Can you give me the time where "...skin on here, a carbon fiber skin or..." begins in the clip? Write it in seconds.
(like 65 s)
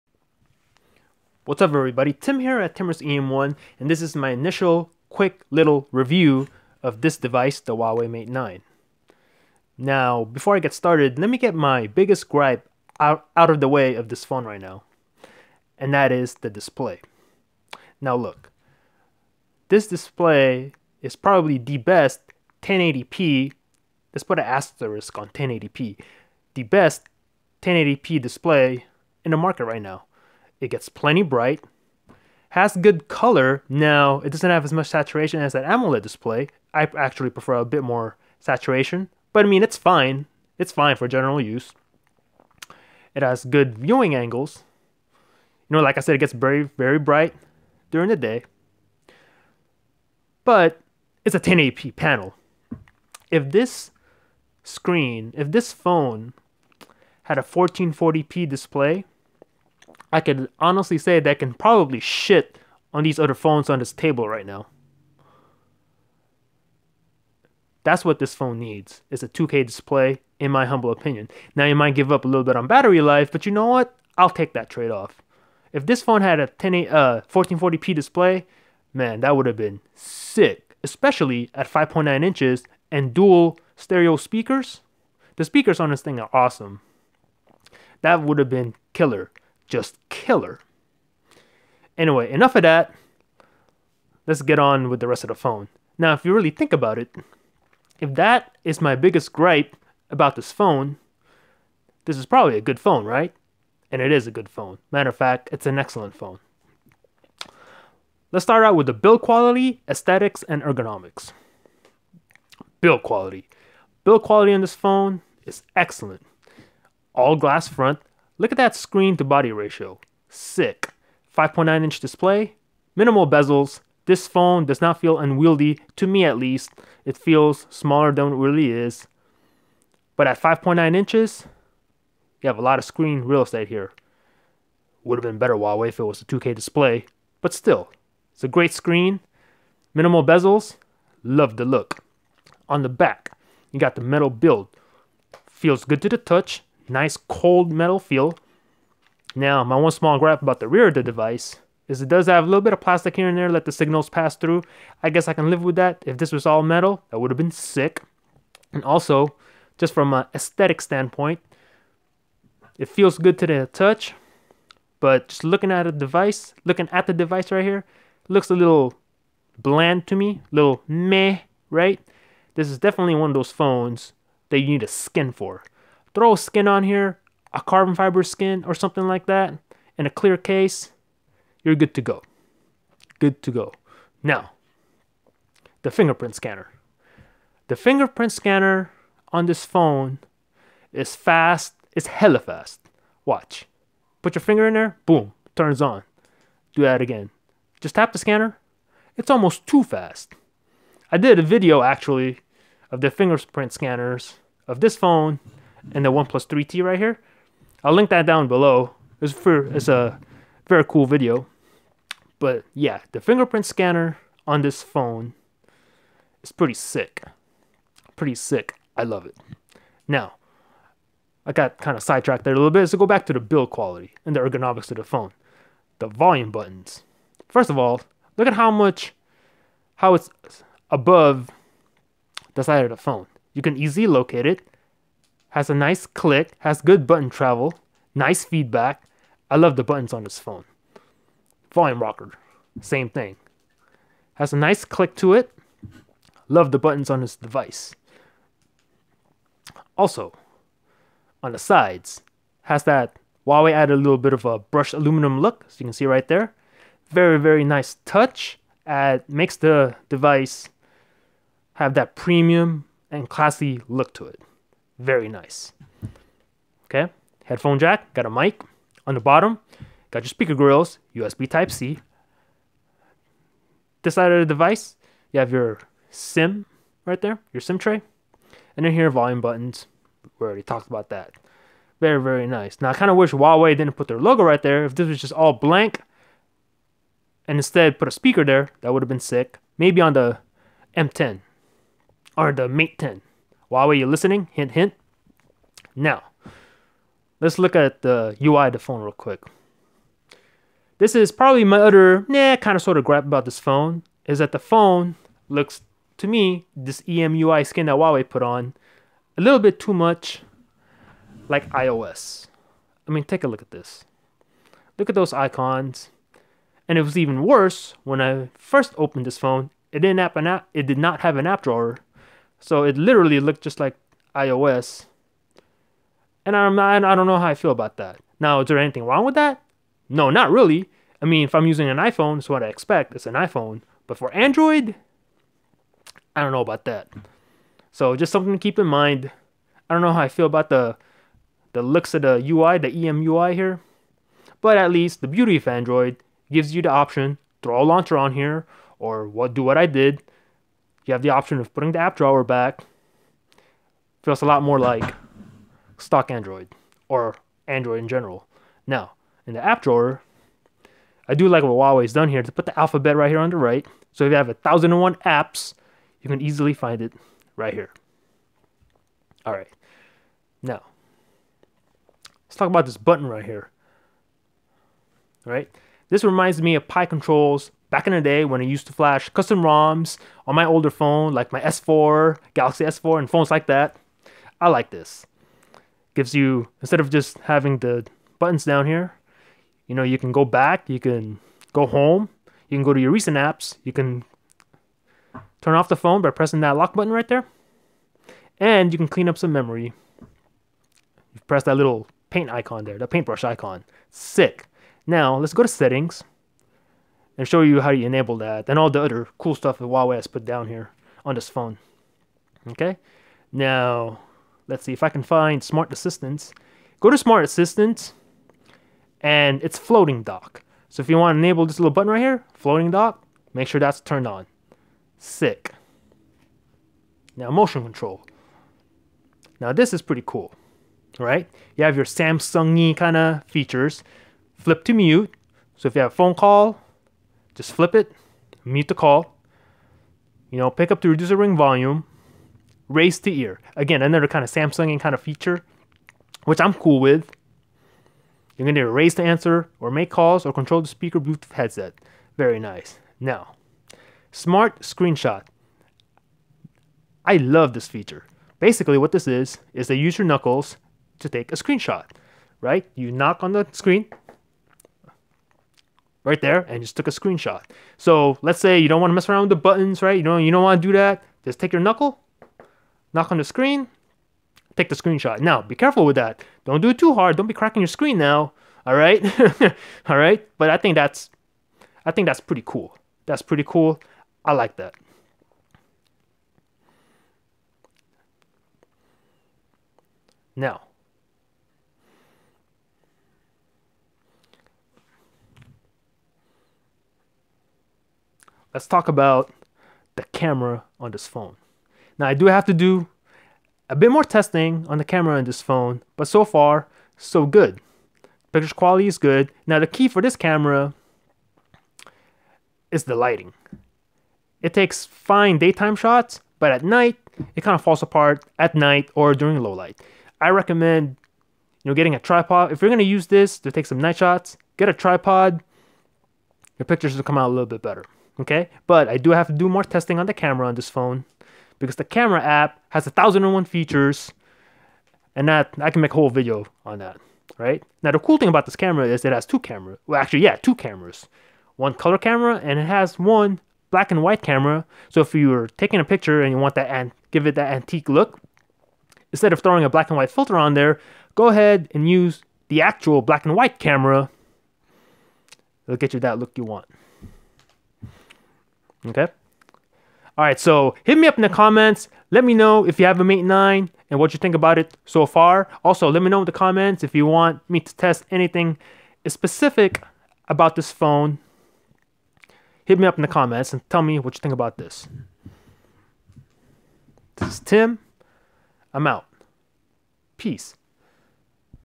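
176 s.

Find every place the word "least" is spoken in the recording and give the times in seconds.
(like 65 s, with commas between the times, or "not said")
126 s, 344 s.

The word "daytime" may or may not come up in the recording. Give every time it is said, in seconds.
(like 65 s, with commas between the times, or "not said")
515 s.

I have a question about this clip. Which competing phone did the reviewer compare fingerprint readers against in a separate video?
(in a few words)
OnePlus 3T.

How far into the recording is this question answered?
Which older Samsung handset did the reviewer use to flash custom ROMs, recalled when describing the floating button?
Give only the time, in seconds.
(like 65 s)
382 s.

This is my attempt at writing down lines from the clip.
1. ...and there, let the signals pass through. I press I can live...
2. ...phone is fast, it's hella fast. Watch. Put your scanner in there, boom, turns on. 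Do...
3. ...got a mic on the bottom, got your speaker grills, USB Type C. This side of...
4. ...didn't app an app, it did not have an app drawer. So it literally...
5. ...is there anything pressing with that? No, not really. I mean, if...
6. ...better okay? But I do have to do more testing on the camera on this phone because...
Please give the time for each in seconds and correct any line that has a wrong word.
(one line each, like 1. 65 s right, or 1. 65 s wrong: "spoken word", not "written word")
1. 153 s wrong: "guess", not "press"
2. 189 s wrong: "finger", not "scanner"
3. 268 s right
4. 319 s right
5. 328 s wrong: "wrong", not "pressing"
6. 527 s right.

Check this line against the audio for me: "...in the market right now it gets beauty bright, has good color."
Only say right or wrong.
wrong.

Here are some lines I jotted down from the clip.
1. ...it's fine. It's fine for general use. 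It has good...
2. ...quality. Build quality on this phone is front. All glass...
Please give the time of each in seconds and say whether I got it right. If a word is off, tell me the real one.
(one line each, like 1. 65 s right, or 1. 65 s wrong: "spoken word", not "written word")
1. 39 s right
2. 113 s wrong: "excellent", not "front".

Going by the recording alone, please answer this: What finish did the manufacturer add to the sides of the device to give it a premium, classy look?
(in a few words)
brushed aluminum.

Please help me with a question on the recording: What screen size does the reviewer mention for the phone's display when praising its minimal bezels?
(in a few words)
5.9 inches.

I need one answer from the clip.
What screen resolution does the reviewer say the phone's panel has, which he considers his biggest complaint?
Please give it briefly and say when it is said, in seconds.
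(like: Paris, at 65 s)
1080p, at 50 s.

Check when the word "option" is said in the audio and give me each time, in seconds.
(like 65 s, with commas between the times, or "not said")
346 s, 351 s.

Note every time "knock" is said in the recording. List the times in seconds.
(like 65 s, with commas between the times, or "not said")
463 s, 473 s.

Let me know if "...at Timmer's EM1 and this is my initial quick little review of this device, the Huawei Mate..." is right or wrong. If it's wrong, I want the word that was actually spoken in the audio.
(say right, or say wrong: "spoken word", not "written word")
right.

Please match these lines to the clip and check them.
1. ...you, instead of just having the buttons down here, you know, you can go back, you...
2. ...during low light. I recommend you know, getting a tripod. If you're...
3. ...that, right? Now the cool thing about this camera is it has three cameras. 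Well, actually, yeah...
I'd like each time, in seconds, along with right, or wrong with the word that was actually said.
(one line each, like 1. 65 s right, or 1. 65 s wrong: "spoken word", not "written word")
1. 386 s right
2. 519 s right
3. 536 s wrong: "two", not "three".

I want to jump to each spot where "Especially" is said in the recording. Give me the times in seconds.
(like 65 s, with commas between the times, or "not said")
80 s.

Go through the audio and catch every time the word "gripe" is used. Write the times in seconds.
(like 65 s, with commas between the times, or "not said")
12 s, 99 s, 150 s, 303 s.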